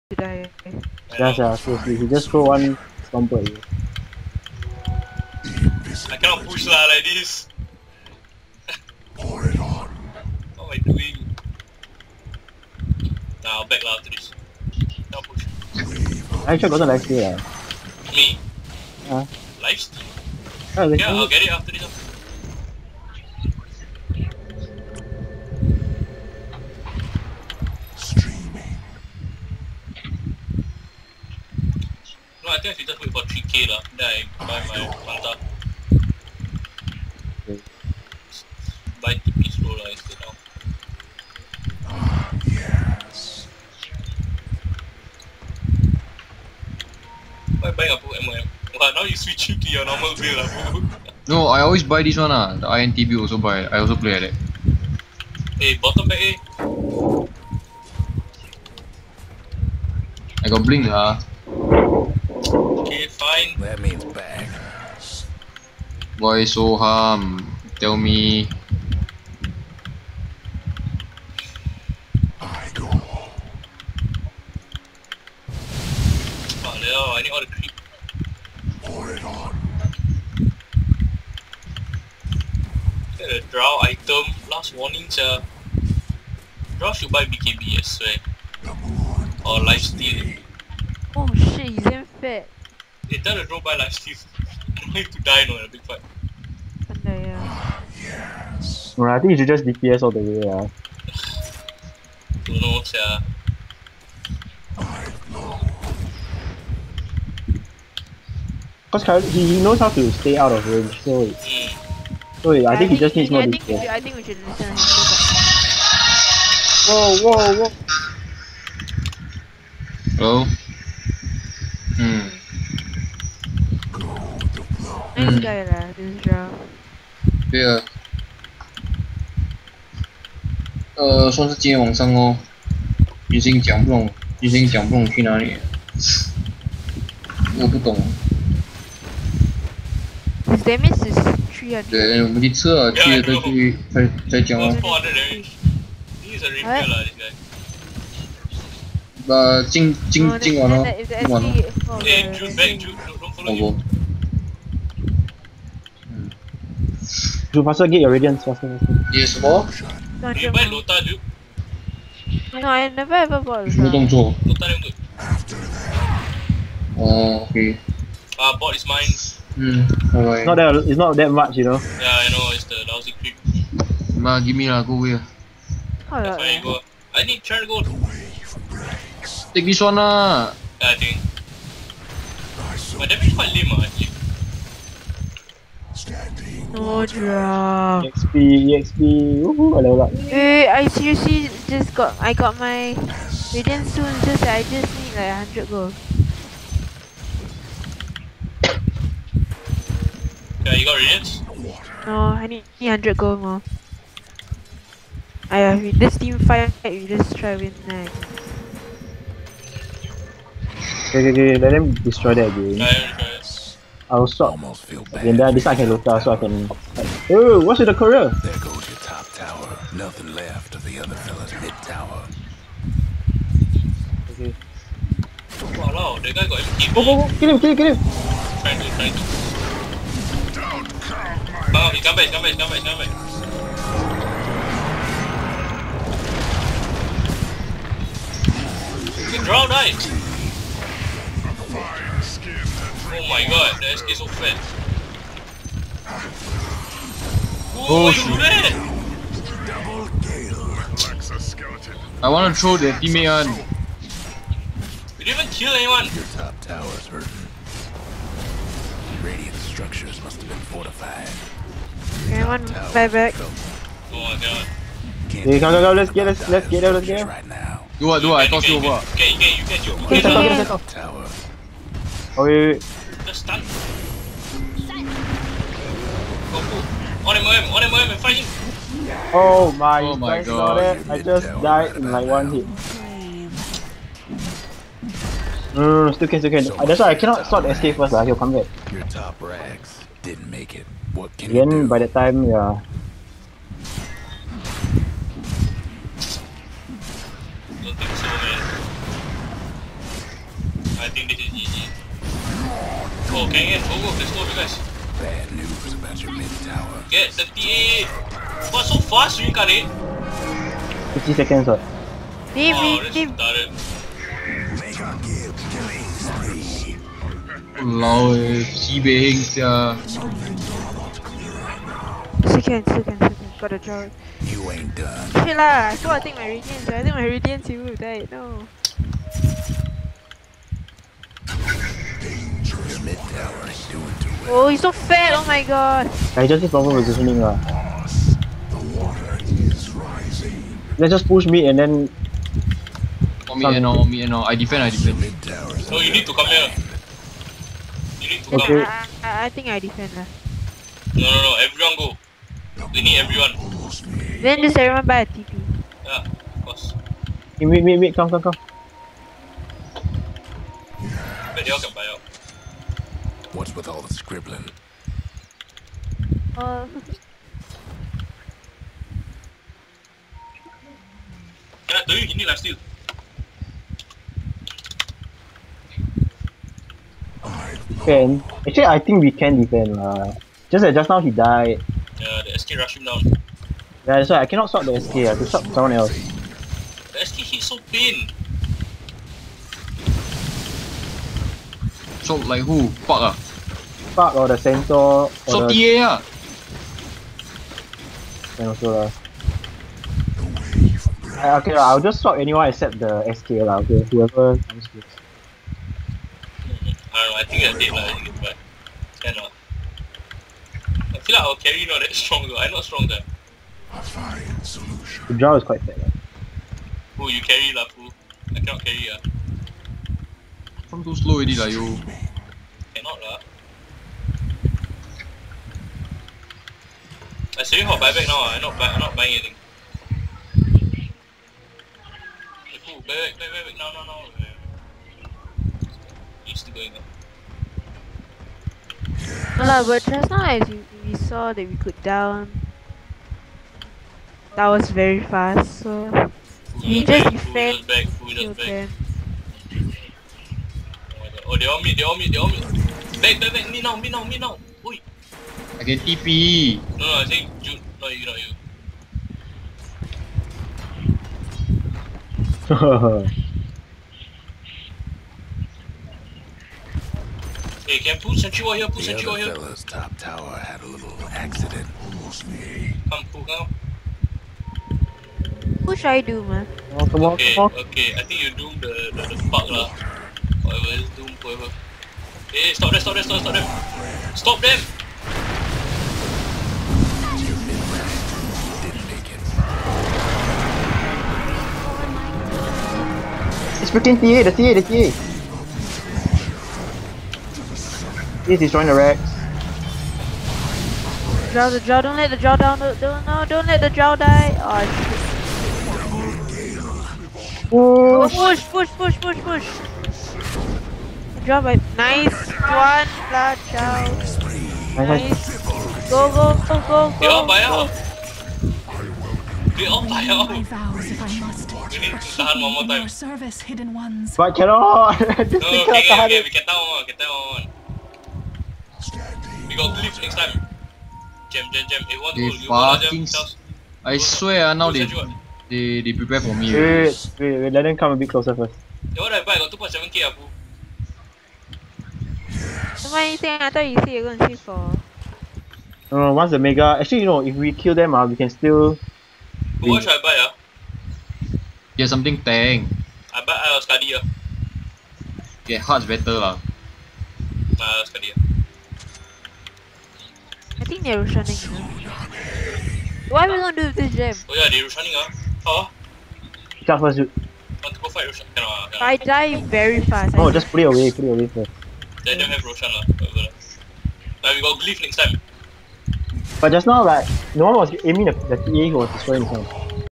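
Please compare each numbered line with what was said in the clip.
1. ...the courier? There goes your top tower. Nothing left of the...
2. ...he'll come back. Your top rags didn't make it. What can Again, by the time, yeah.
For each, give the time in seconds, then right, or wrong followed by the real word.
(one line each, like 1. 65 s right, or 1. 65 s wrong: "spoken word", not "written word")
1. 217 s right
2. 288 s right.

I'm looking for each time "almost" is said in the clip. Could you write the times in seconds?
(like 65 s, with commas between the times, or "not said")
214 s, 472 s.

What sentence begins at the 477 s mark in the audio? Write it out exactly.
Okay, okay, I think you do the, the, the fuck lah.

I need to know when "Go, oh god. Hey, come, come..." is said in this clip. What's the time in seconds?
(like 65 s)
263 s.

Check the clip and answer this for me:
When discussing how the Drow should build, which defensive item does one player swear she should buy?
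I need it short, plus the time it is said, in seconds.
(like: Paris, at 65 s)
BKB, at 87 s.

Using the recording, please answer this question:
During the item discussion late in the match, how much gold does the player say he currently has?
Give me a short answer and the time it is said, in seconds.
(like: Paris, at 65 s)
2.7k, at 539 s.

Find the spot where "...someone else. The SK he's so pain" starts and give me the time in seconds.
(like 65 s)
385 s.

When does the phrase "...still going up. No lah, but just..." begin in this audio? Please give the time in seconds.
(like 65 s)
436 s.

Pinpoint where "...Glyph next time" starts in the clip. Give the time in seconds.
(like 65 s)
574 s.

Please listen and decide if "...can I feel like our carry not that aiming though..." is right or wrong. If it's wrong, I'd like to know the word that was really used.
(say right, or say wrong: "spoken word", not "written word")
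wrong: "strong", not "aiming".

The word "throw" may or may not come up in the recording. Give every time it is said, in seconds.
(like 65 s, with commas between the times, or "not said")
2 s, 252 s.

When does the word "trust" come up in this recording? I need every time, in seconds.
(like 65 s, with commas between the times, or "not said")
not said.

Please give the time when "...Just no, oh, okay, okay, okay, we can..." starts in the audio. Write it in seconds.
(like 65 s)
525 s.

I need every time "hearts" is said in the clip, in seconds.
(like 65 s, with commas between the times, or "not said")
555 s.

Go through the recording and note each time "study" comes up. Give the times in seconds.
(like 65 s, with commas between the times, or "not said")
553 s, 558 s.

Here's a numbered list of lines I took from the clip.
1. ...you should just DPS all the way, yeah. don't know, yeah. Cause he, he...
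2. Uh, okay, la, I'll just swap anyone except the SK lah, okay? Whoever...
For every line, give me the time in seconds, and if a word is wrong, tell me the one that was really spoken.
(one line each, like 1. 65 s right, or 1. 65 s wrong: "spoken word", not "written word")
1. 99 s right
2. 401 s right.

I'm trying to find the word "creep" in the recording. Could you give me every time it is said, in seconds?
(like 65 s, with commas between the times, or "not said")
77 s, 173 s.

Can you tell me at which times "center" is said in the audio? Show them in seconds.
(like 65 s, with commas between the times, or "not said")
394 s.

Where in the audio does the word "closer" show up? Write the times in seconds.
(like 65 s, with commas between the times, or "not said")
538 s.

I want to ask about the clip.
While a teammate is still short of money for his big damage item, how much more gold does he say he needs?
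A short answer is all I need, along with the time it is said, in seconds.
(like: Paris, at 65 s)
300, at 202 s.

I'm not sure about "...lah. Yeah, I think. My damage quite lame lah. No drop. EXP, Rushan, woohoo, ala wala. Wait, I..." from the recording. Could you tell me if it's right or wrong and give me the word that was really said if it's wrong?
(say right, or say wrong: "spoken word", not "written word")
wrong: "EXP", not "Rushan".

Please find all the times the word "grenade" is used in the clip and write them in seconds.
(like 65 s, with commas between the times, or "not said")
not said.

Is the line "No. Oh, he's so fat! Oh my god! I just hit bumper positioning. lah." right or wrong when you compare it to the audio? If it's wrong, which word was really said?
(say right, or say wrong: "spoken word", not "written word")
wrong: "proper", not "bumper".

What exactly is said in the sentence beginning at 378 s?
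Can actually I think we can defend lah.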